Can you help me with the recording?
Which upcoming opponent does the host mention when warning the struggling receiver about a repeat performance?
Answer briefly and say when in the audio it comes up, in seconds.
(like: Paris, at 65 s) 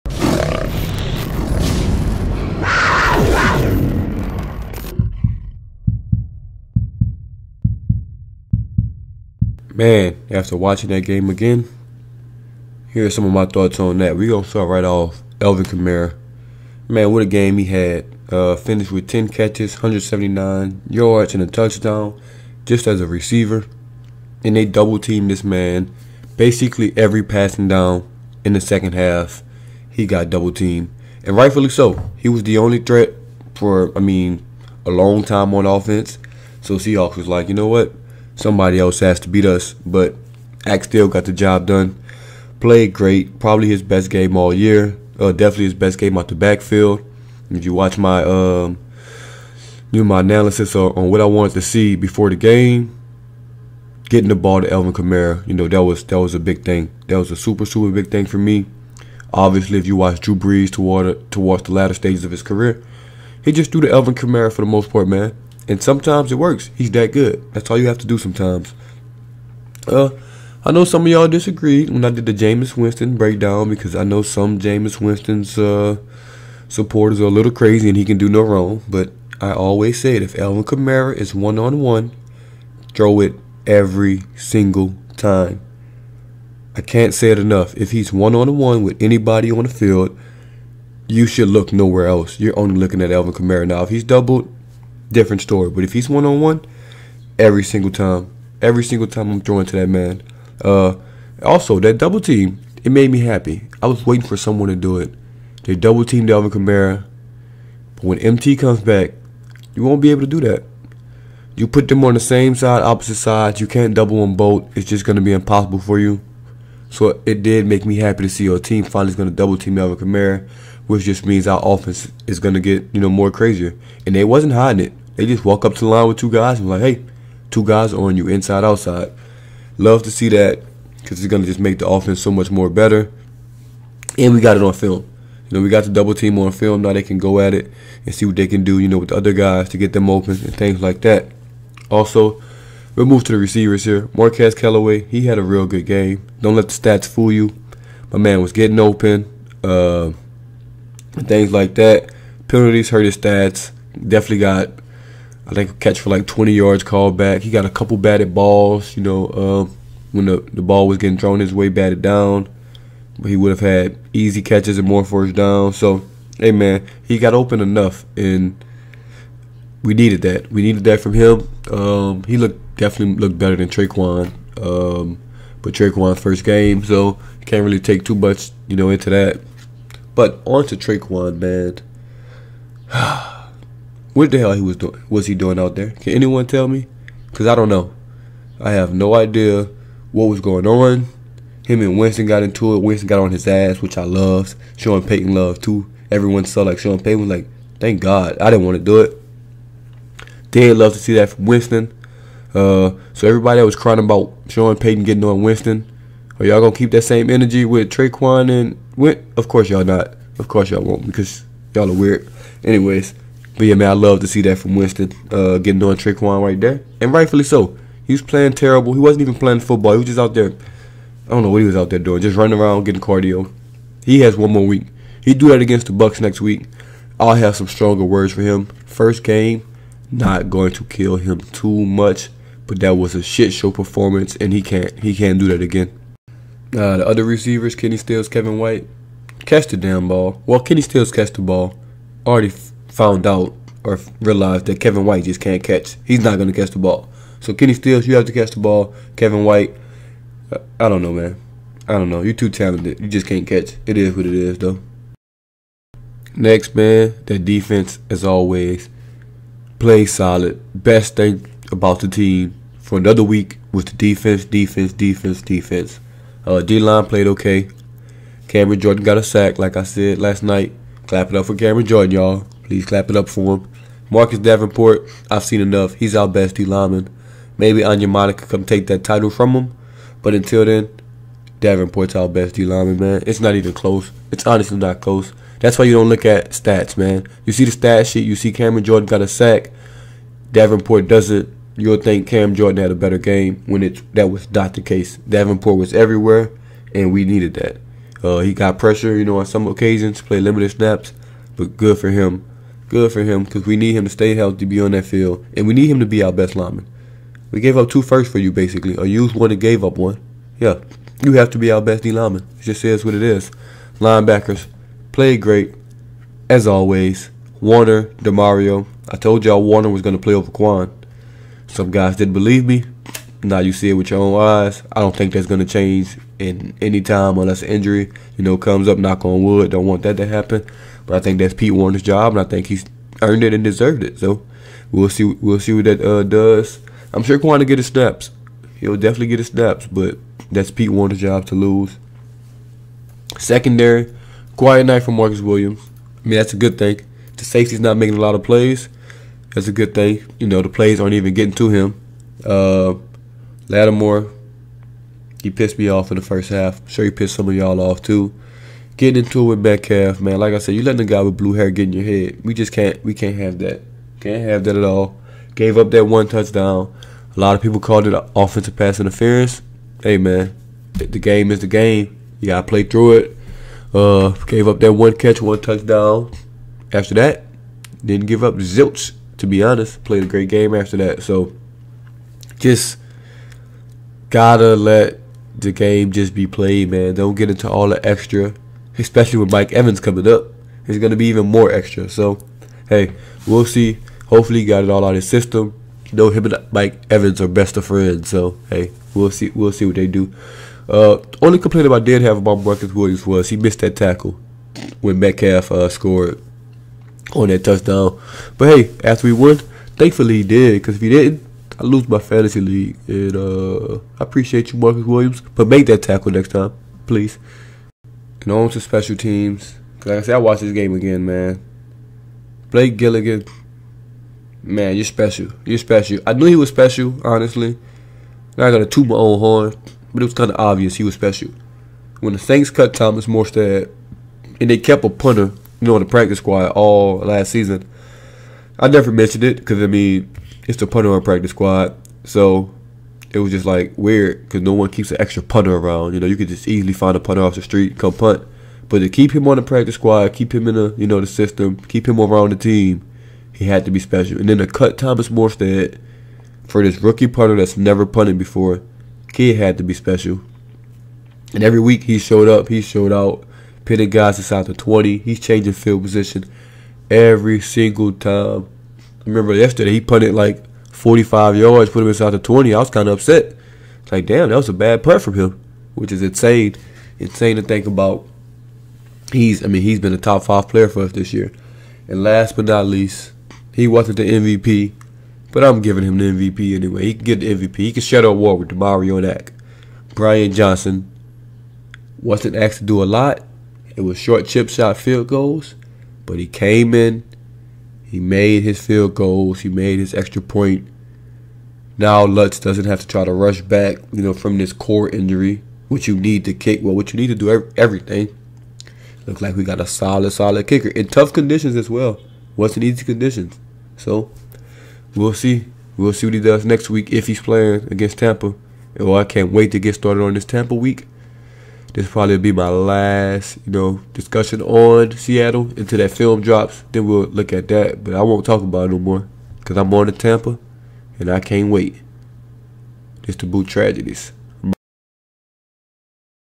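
Bucs, at 225 s.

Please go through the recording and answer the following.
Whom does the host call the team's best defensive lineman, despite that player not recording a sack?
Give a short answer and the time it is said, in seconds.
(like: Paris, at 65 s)
Marcus Davenport, at 274 s.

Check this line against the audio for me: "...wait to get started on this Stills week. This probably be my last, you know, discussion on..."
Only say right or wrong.
wrong.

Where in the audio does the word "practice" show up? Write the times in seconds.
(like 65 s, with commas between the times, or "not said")
436 s, 441 s, 449 s.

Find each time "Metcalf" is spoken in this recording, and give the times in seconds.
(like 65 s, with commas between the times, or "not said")
359 s, 405 s.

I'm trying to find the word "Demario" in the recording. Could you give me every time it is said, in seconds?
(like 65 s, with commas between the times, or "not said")
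318 s, 488 s.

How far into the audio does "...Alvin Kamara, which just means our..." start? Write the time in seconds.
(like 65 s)
119 s.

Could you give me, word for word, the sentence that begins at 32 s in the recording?
He was the only threat for, I mean, a long time on offense.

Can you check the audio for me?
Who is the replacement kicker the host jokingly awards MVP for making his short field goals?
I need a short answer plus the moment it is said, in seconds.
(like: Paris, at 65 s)
Brian Johnson, at 490 s.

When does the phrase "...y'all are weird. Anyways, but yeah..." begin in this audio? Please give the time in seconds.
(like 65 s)
211 s.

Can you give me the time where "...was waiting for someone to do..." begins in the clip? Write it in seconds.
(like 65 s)
103 s.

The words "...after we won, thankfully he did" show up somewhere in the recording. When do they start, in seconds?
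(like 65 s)
409 s.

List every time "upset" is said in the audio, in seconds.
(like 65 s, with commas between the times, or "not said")
473 s.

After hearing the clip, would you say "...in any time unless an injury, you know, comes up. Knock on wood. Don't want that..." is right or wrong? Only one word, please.
right.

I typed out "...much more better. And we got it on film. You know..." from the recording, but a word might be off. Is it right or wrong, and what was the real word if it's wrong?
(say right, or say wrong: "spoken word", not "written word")
right.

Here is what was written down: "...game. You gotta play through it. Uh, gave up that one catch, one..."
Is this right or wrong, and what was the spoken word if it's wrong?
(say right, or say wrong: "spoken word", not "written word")
right.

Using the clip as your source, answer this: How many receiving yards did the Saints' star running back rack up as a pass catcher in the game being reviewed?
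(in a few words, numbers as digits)
179.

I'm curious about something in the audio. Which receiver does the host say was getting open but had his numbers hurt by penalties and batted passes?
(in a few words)
Marquez Callaway.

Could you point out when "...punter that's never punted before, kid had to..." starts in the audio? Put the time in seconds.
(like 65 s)
457 s.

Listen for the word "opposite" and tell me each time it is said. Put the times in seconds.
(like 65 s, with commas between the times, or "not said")
112 s.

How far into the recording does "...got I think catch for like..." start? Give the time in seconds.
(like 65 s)
154 s.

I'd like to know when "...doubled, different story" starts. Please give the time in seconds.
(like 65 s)
94 s.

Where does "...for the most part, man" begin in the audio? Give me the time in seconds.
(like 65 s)
64 s.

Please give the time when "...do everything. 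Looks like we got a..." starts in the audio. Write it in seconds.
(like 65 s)
507 s.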